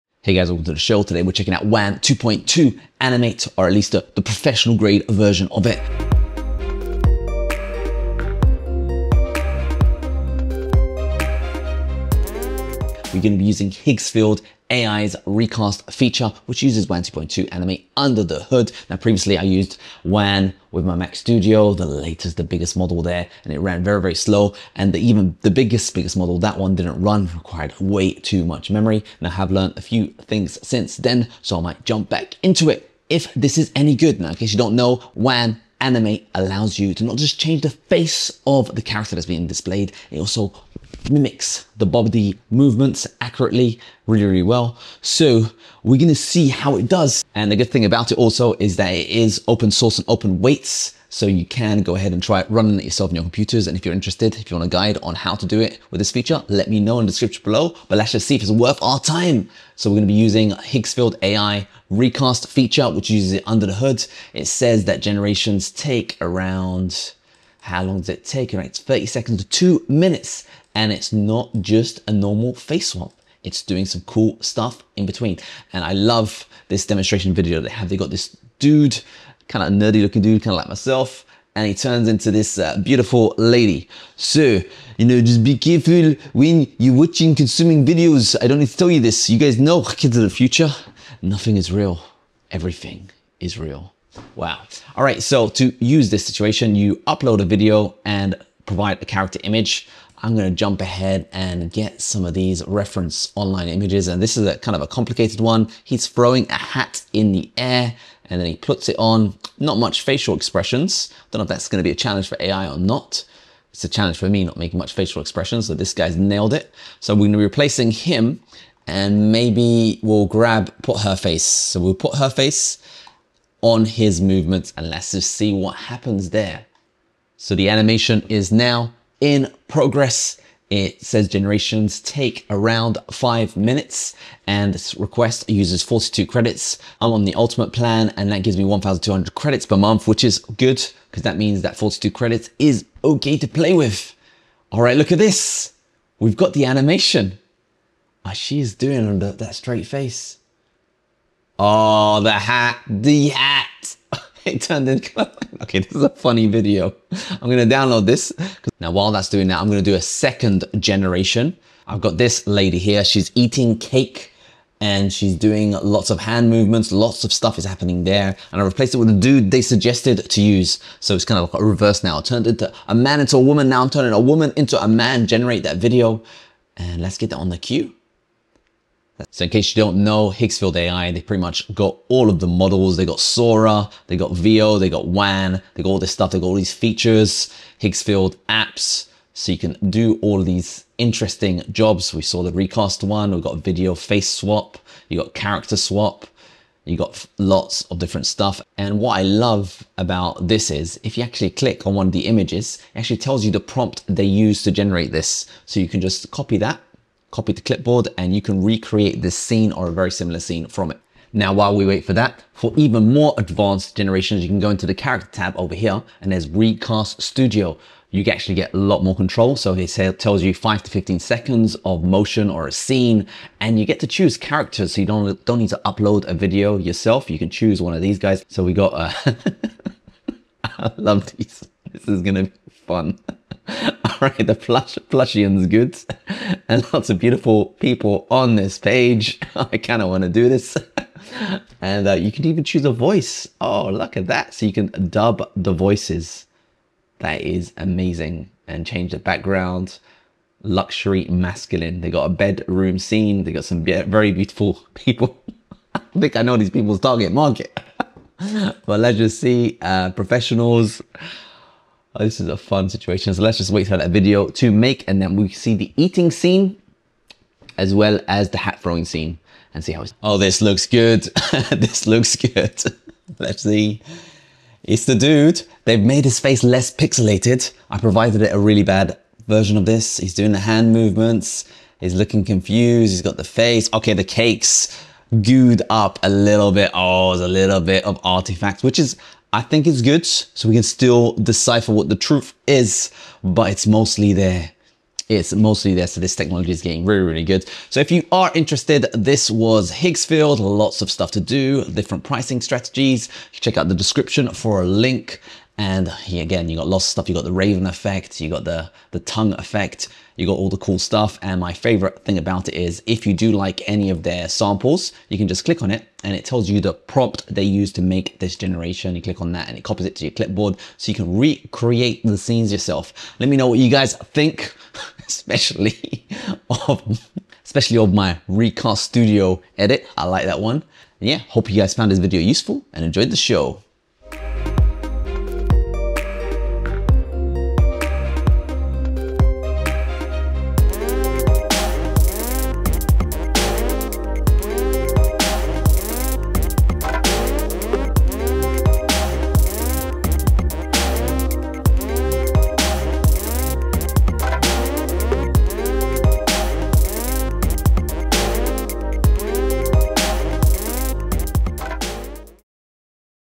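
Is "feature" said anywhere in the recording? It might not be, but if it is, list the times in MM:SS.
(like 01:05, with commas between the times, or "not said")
00:15, 00:56, 01:02, 03:06.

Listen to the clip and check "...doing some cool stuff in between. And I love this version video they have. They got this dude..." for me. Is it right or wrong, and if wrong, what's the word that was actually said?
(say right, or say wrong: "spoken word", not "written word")
wrong: "demonstration", not "version".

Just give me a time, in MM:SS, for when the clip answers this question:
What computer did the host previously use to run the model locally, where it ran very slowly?
00:20.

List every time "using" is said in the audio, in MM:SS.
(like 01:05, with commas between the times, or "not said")
00:13, 01:00.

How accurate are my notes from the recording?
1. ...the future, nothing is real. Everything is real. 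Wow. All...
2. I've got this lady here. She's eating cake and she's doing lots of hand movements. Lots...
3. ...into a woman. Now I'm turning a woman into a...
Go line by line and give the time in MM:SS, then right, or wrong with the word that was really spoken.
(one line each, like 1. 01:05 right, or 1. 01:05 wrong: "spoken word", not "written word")
1. 01:30 right
2. 02:41 right
3. 02:53 right.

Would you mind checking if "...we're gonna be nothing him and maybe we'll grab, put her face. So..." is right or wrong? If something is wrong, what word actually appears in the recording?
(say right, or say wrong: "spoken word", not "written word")
wrong: "replacing", not "nothing".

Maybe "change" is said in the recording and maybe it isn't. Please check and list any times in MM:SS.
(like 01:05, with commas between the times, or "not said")
00:37, 04:08.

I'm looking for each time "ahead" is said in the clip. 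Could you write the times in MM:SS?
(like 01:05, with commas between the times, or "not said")
00:51, 01:40.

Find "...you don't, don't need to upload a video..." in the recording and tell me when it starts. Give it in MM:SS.
03:45.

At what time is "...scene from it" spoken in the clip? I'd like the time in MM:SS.
03:30.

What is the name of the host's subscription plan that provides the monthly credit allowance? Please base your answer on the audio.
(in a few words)
Ultimate plan.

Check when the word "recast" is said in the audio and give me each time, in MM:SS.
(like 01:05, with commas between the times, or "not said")
00:15, 01:01, 03:12, 03:36, 05:28.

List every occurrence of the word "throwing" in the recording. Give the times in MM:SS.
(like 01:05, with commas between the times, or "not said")
01:46, 04:28.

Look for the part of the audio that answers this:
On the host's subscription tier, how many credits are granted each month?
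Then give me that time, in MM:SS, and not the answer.
02:18.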